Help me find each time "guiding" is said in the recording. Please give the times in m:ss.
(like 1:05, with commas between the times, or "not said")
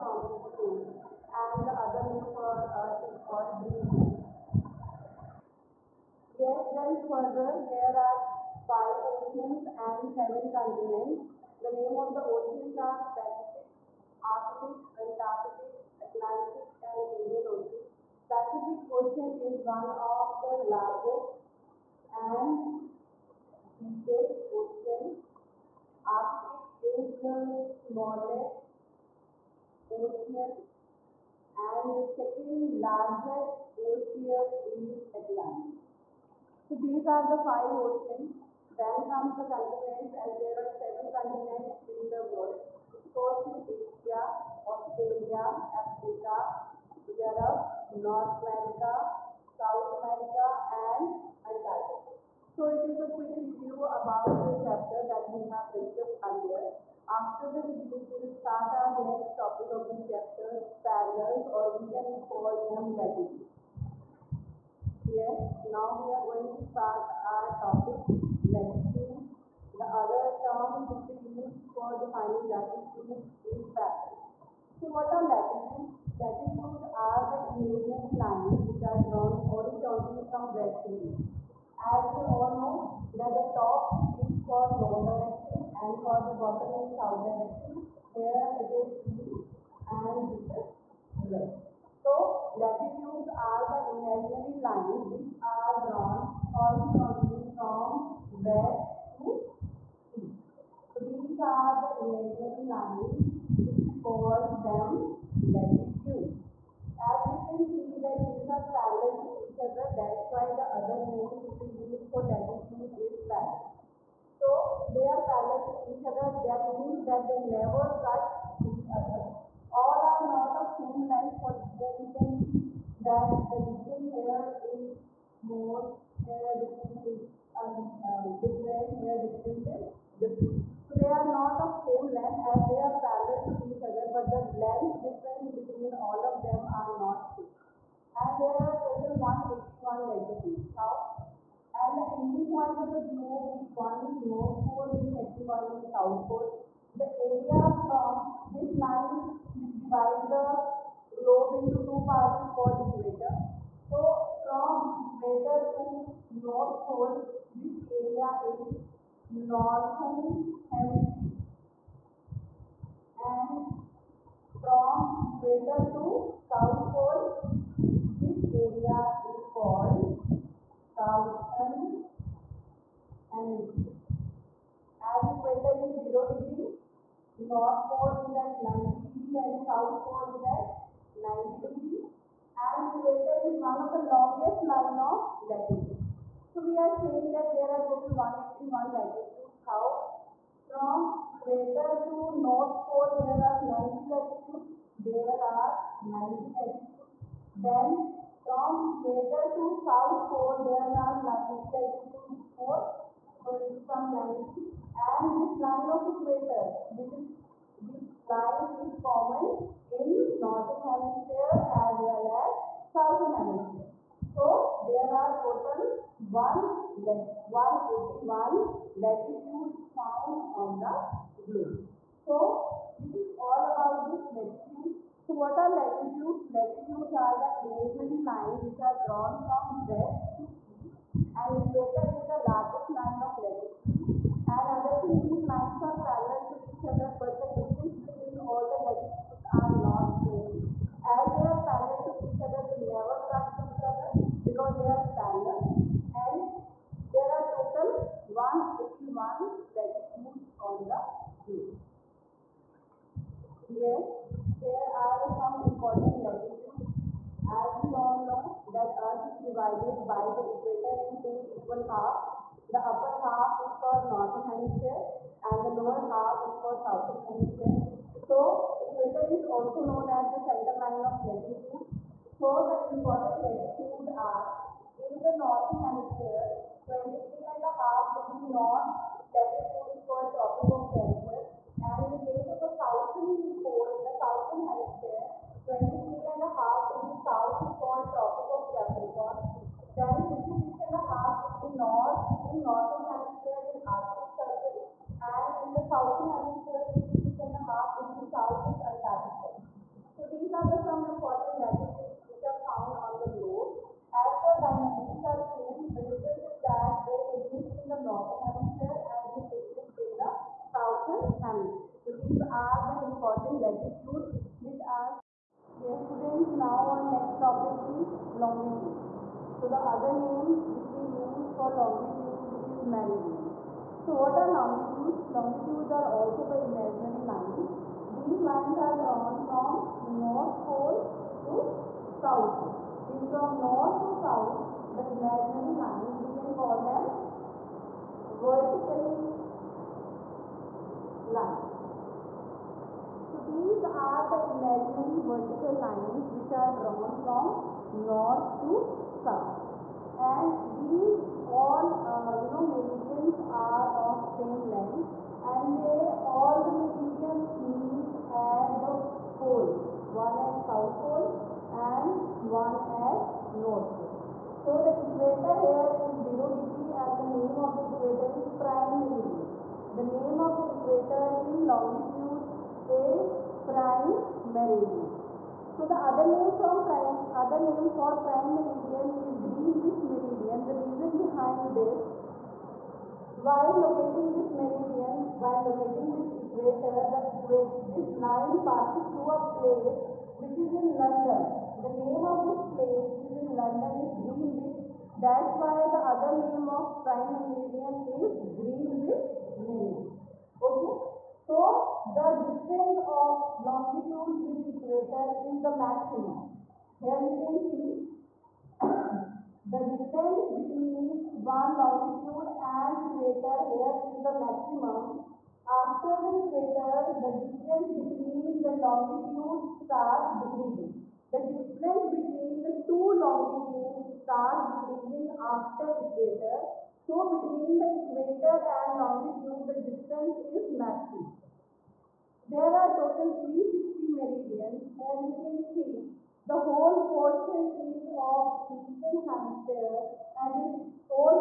not said.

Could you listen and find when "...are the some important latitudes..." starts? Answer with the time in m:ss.
5:00.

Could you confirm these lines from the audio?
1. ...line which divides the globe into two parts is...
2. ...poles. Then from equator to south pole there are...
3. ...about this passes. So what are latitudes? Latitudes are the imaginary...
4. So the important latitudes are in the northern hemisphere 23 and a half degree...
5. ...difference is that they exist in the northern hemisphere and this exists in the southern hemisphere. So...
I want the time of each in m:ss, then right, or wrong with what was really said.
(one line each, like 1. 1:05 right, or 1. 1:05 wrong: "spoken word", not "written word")
1. 2:28 right
2. 3:16 wrong: "latitudes", not "poles"
3. 3:43 wrong: "latitudes", not "passes"
4. 4:32 right
5. 5:06 right.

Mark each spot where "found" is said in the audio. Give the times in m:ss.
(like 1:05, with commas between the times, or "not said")
3:39, 5:02.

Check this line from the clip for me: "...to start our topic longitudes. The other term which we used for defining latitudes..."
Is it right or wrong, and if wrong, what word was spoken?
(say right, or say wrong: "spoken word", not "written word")
wrong: "latitudes", not "longitudes".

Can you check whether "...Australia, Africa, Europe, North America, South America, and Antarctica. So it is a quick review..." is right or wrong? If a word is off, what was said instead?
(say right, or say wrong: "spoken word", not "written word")
right.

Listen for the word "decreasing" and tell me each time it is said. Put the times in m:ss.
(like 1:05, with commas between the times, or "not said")
7:00, 7:04.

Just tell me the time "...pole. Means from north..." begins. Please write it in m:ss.
5:32.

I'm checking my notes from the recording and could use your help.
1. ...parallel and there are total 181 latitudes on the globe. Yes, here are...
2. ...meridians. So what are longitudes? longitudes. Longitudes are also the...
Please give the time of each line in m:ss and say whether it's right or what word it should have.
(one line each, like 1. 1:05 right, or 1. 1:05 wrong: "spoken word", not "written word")
1. 4:05 right
2. 5:22 right.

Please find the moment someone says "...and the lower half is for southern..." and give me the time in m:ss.
4:25.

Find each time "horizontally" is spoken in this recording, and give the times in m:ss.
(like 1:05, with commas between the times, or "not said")
1:19, 1:36.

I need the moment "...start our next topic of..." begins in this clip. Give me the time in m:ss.
0:58.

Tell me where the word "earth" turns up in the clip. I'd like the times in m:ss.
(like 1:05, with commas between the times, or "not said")
0:02, 4:19.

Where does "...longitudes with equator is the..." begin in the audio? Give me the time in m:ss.
6:43.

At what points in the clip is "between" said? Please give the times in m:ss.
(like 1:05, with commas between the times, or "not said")
2:15, 3:57, 6:50, 6:57, 7:02, 7:07.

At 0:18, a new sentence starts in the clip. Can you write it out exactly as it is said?
Pacific Ocean is one of the largest and deepest ocean.